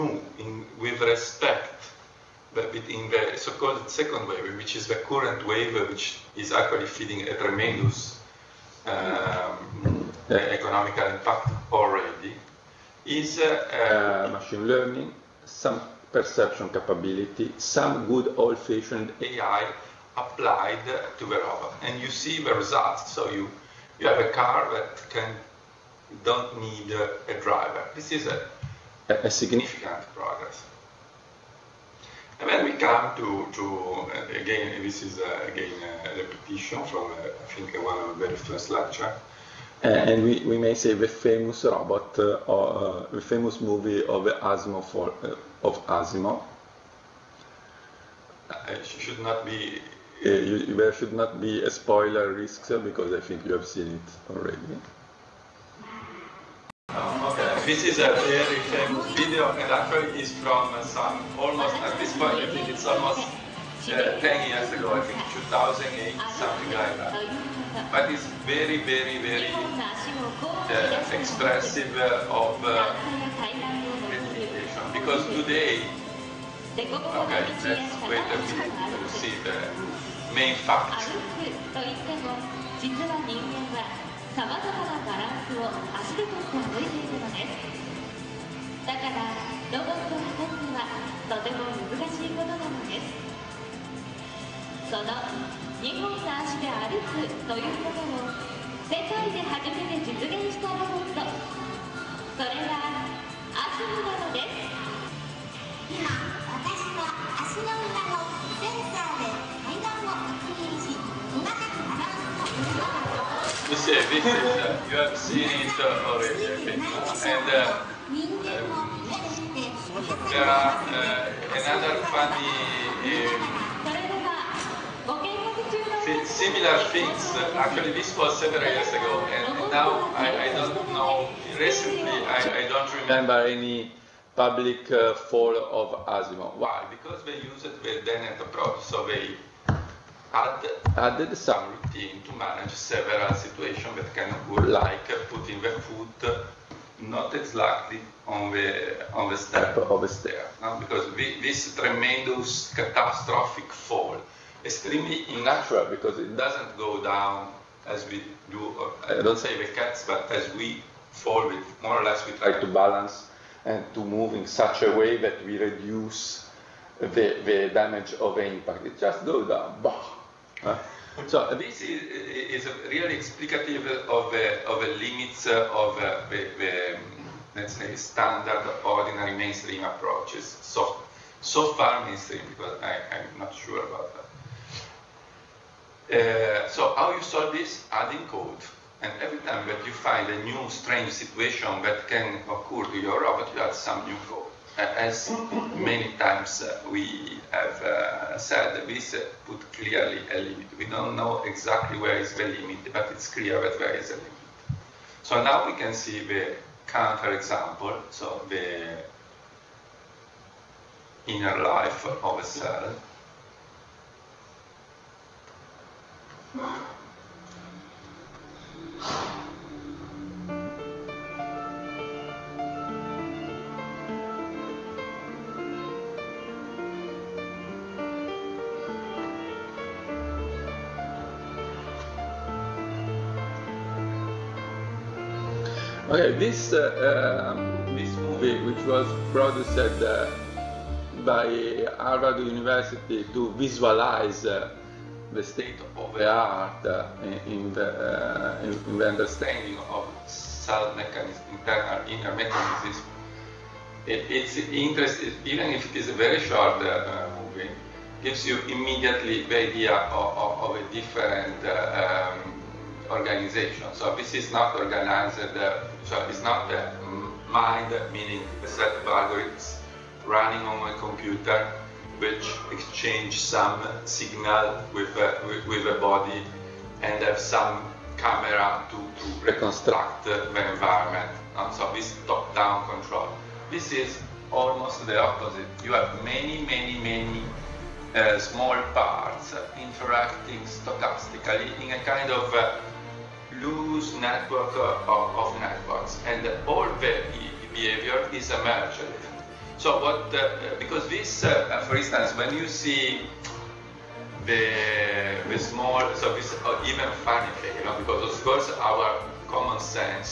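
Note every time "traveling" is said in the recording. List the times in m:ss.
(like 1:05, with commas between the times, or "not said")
not said.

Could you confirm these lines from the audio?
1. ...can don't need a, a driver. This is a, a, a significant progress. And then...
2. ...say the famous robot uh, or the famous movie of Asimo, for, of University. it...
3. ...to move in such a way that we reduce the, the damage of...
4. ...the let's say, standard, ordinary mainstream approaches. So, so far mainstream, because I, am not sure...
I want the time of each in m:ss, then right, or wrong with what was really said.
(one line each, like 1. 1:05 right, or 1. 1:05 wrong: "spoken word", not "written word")
1. 0:25 right
2. 0:40 wrong: "Asimo", not "University"
3. 2:43 right
4. 2:56 right.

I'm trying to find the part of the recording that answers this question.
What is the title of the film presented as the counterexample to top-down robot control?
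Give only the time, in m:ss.
3:28.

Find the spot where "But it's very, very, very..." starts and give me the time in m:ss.
1:07.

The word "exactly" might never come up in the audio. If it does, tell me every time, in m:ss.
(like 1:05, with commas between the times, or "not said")
2:27, 3:21.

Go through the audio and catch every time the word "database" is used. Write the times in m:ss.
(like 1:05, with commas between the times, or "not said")
not said.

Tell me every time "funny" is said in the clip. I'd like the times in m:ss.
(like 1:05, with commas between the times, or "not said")
2:02, 5:07.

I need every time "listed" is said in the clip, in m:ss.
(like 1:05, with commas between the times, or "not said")
not said.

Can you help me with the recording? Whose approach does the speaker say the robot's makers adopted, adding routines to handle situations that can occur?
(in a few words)
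Dennett.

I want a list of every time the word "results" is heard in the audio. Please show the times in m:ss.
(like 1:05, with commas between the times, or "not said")
0:22.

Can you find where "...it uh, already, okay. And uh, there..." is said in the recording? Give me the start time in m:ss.
1:55.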